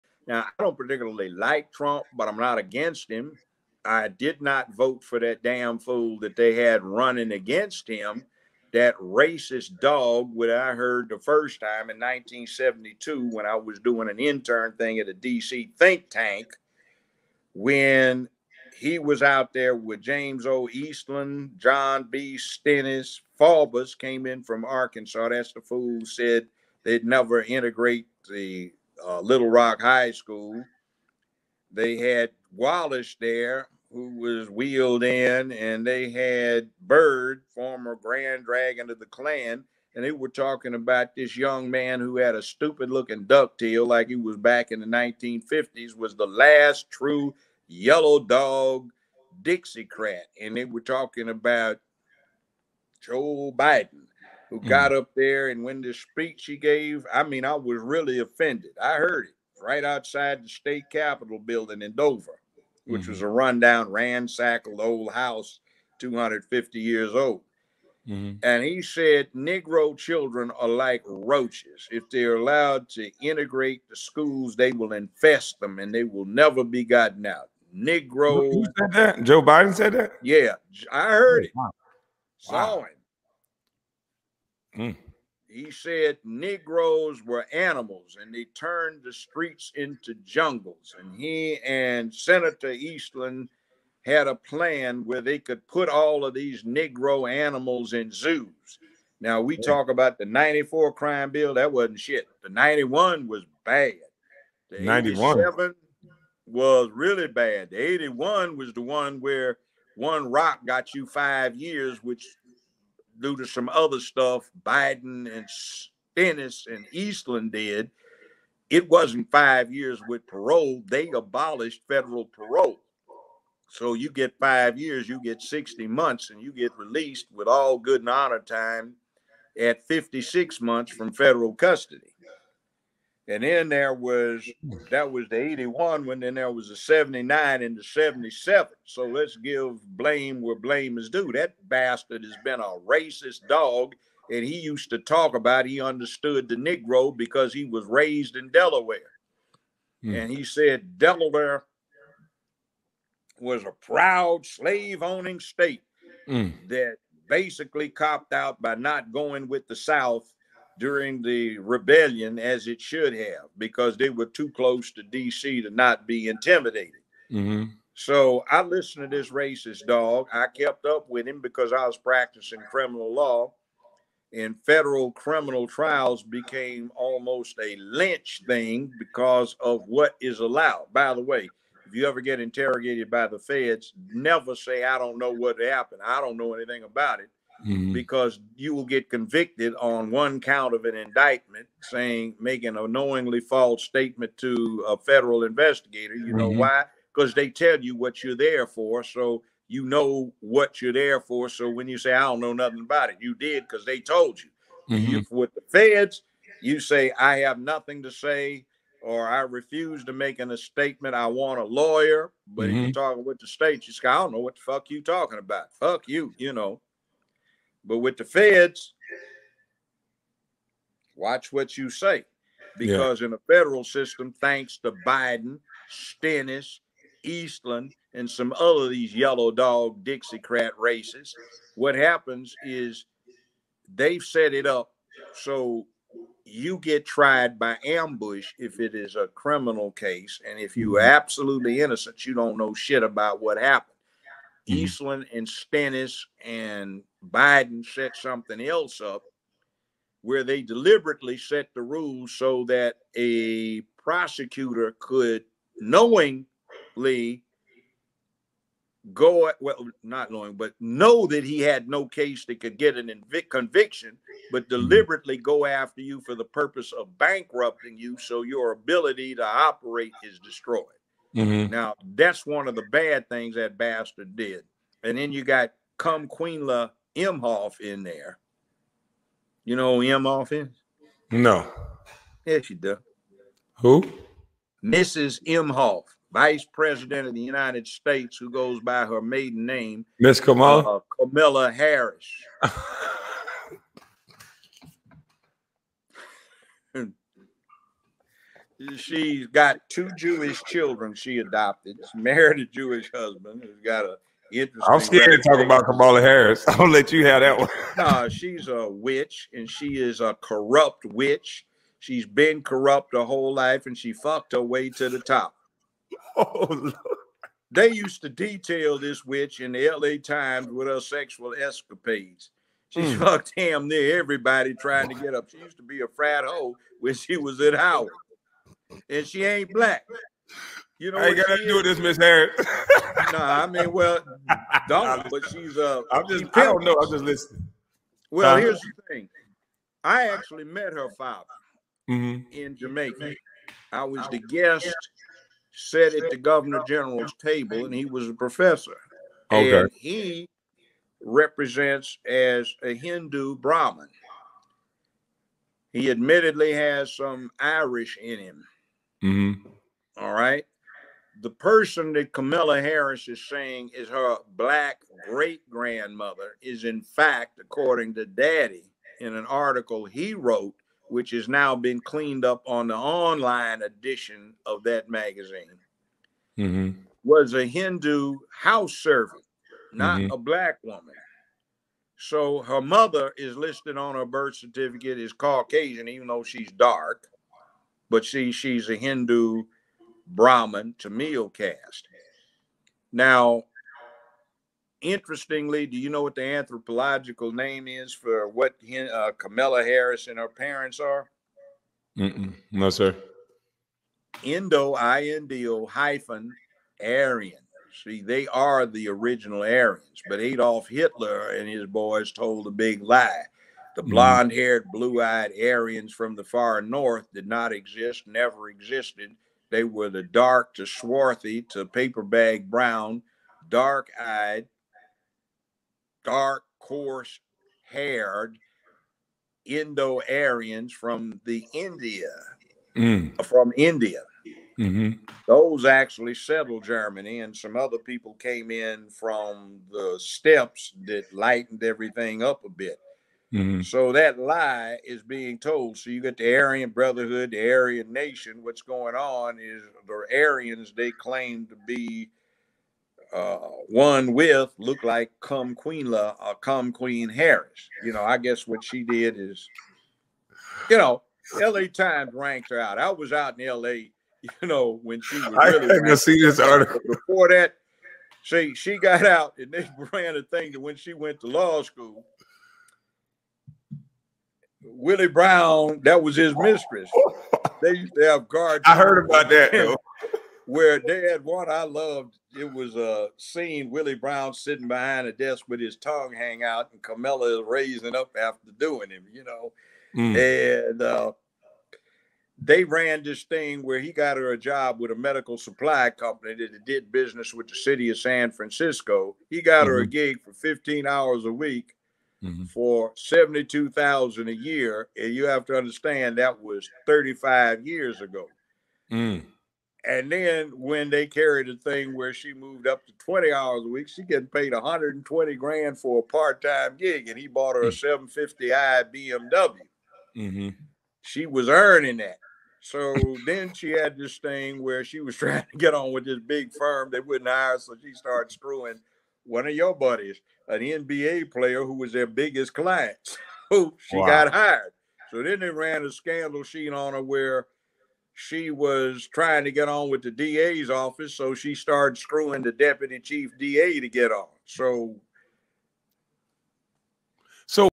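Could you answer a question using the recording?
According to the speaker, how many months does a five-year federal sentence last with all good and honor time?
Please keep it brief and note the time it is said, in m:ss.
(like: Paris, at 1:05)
56 months, at 2:09.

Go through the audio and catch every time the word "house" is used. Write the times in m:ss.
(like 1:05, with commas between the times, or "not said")
1:05, 6:18.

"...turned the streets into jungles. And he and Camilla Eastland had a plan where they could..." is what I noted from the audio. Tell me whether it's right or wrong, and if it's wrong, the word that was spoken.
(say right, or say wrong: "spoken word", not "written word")
wrong: "Senator", not "Camilla".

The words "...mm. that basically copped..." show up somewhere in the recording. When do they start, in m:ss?
2:36.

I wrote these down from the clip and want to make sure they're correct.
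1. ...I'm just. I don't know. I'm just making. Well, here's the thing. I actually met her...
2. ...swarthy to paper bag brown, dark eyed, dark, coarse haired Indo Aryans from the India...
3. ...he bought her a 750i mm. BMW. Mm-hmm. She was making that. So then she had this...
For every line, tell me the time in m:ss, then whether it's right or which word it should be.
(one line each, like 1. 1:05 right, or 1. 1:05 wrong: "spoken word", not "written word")
1. 5:36 wrong: "listening", not "making"
2. 7:00 right
3. 8:37 wrong: "earning", not "making".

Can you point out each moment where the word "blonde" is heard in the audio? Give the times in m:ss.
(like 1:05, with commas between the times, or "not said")
6:54.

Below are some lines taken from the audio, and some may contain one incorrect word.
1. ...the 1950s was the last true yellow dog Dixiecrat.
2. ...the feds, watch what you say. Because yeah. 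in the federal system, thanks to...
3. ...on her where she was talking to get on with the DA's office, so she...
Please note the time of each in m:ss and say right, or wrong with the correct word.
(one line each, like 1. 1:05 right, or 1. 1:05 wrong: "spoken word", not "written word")
1. 0:44 right
2. 3:38 right
3. 8:56 wrong: "trying", not "talking".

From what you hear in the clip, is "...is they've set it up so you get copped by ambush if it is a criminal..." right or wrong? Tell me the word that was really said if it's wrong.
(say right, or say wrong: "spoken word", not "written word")
wrong: "tried", not "copped".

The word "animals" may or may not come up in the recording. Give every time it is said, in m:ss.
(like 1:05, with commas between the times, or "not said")
1:27, 1:37.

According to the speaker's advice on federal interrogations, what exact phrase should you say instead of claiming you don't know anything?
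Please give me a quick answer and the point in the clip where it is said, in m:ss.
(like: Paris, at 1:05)
I have nothing to say, at 3:27.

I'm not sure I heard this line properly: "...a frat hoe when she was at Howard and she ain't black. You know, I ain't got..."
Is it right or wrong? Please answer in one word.
right.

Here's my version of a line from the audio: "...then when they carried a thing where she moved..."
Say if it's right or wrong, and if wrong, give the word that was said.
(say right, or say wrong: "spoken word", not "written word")
right.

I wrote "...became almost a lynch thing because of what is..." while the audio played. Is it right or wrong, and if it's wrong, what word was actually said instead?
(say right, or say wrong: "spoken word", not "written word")
right.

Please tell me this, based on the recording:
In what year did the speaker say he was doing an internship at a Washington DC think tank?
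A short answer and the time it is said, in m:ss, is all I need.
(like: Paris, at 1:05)
1972, at 0:11.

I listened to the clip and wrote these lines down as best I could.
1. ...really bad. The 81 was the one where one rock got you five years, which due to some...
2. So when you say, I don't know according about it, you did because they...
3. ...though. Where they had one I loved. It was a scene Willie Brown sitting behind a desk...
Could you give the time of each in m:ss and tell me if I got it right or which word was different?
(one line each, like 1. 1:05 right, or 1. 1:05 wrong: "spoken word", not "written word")
1. 1:46 right
2. 3:21 wrong: "nothing", not "according"
3. 7:59 right.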